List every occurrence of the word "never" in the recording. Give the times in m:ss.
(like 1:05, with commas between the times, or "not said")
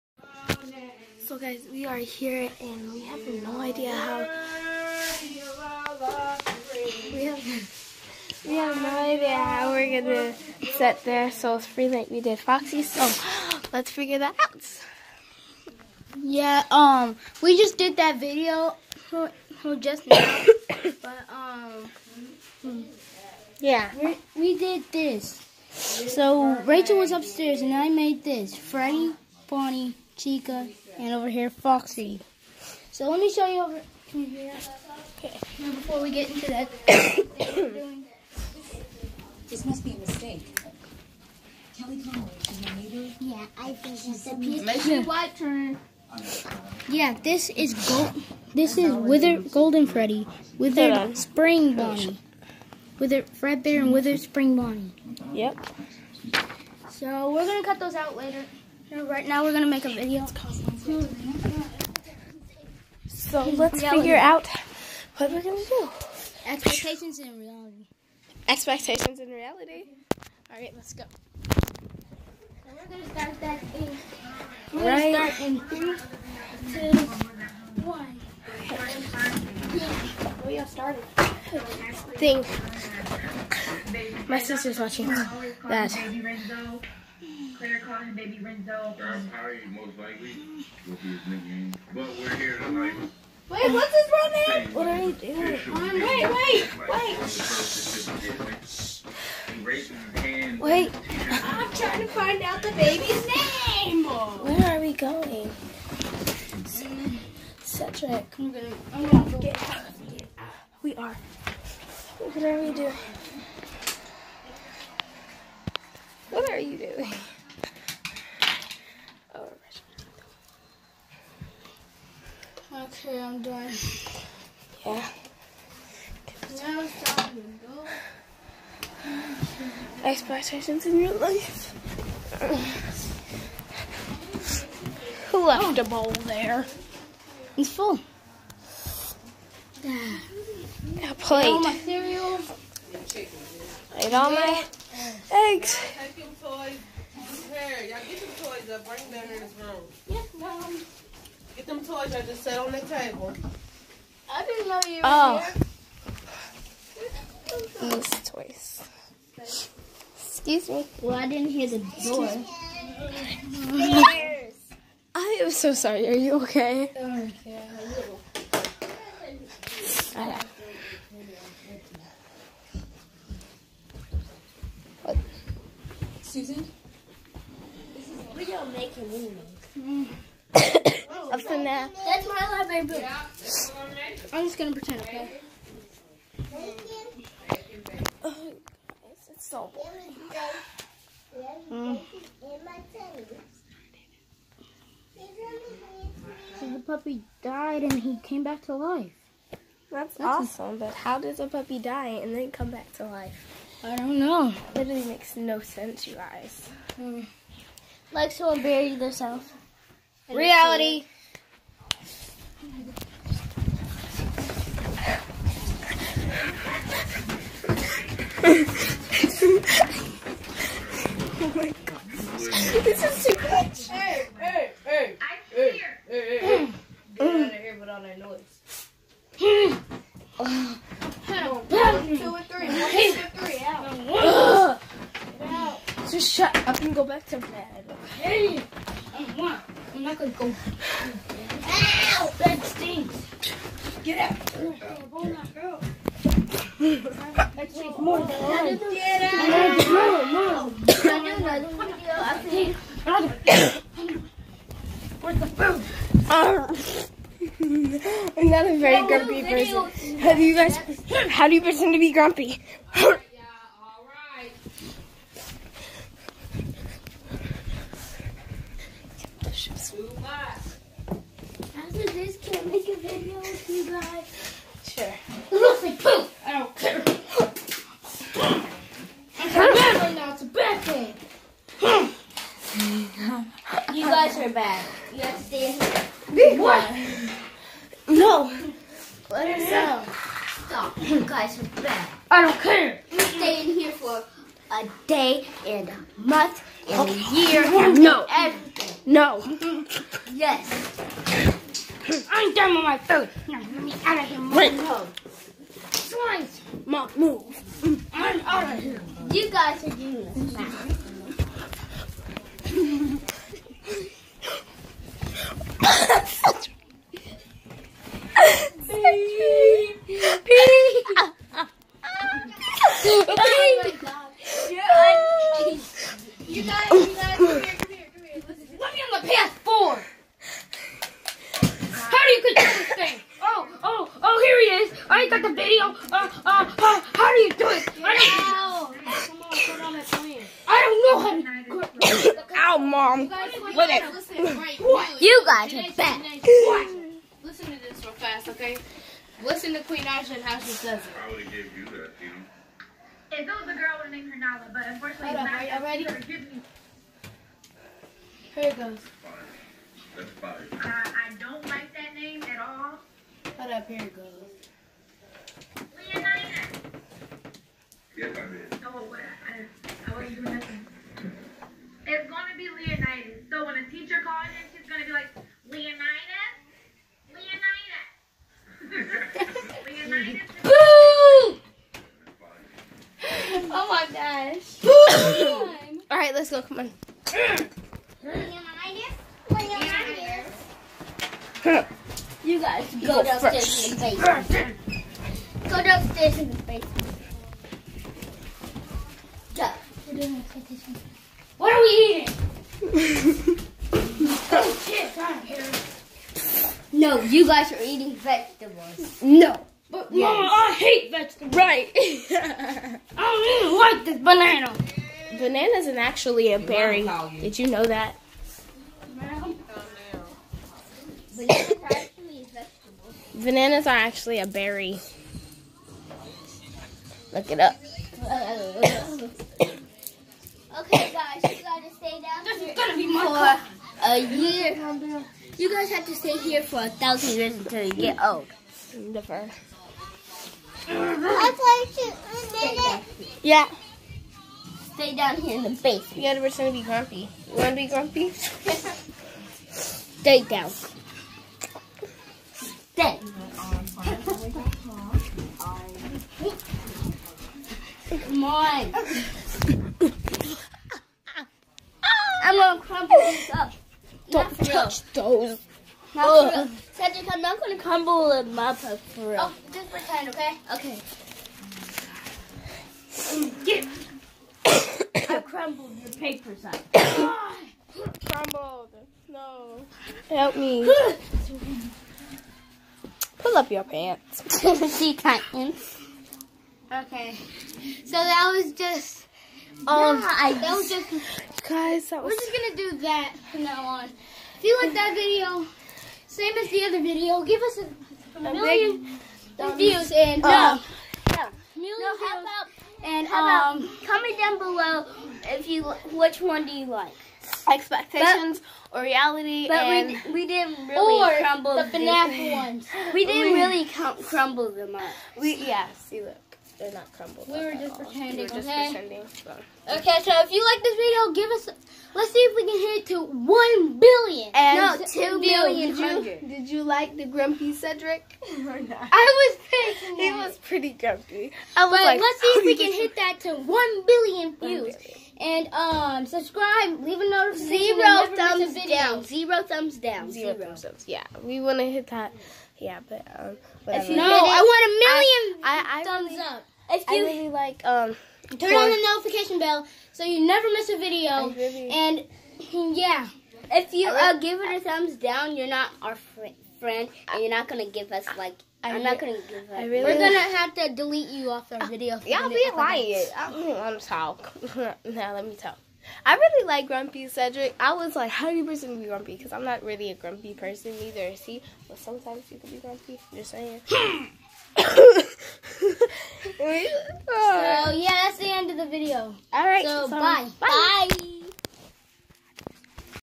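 7:18, 9:10.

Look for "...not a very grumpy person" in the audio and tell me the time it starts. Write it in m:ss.
4:18.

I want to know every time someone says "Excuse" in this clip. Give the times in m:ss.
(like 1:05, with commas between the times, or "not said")
2:40.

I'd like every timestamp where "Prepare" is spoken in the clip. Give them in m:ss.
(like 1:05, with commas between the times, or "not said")
2:27.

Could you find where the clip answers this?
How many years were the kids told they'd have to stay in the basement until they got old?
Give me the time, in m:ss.
7:16.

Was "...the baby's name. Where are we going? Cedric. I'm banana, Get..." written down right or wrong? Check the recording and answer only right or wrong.
wrong.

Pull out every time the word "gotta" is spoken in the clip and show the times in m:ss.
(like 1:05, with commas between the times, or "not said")
7:11, 7:26.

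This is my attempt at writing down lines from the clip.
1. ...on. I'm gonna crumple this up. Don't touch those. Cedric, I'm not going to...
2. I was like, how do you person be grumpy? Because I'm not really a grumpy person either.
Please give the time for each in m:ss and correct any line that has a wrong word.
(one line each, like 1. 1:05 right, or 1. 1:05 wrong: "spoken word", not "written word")
1. 7:38 right
2. 9:27 right.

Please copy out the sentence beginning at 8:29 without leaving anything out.
But and we, we didn't really crumble the FNAF ones.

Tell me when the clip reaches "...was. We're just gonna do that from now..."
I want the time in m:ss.
8:12.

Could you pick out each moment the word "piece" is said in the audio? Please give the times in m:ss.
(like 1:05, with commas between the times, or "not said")
0:44.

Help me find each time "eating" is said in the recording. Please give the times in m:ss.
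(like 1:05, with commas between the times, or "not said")
6:42, 6:47.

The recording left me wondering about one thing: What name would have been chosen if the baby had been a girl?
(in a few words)
Nala.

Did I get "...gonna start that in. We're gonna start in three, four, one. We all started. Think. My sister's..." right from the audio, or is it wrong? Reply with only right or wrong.
wrong.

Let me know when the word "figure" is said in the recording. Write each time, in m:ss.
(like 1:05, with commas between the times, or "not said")
0:13, 1:04.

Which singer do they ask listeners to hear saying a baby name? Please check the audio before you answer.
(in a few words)
Queen Naija.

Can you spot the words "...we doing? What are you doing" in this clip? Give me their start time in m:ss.
1:52.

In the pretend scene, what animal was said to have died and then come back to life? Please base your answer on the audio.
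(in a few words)
A puppy.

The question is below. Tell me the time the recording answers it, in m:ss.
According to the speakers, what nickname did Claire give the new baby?
1:28.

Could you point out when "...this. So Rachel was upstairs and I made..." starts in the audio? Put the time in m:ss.
0:24.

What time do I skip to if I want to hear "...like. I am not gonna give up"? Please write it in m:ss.
9:18.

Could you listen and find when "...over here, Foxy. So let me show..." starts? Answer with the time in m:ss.
0:31.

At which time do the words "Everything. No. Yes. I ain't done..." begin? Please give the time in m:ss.
4:58.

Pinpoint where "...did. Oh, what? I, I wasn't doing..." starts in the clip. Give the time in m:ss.
6:08.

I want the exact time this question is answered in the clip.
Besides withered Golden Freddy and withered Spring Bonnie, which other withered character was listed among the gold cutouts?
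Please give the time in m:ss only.
0:52.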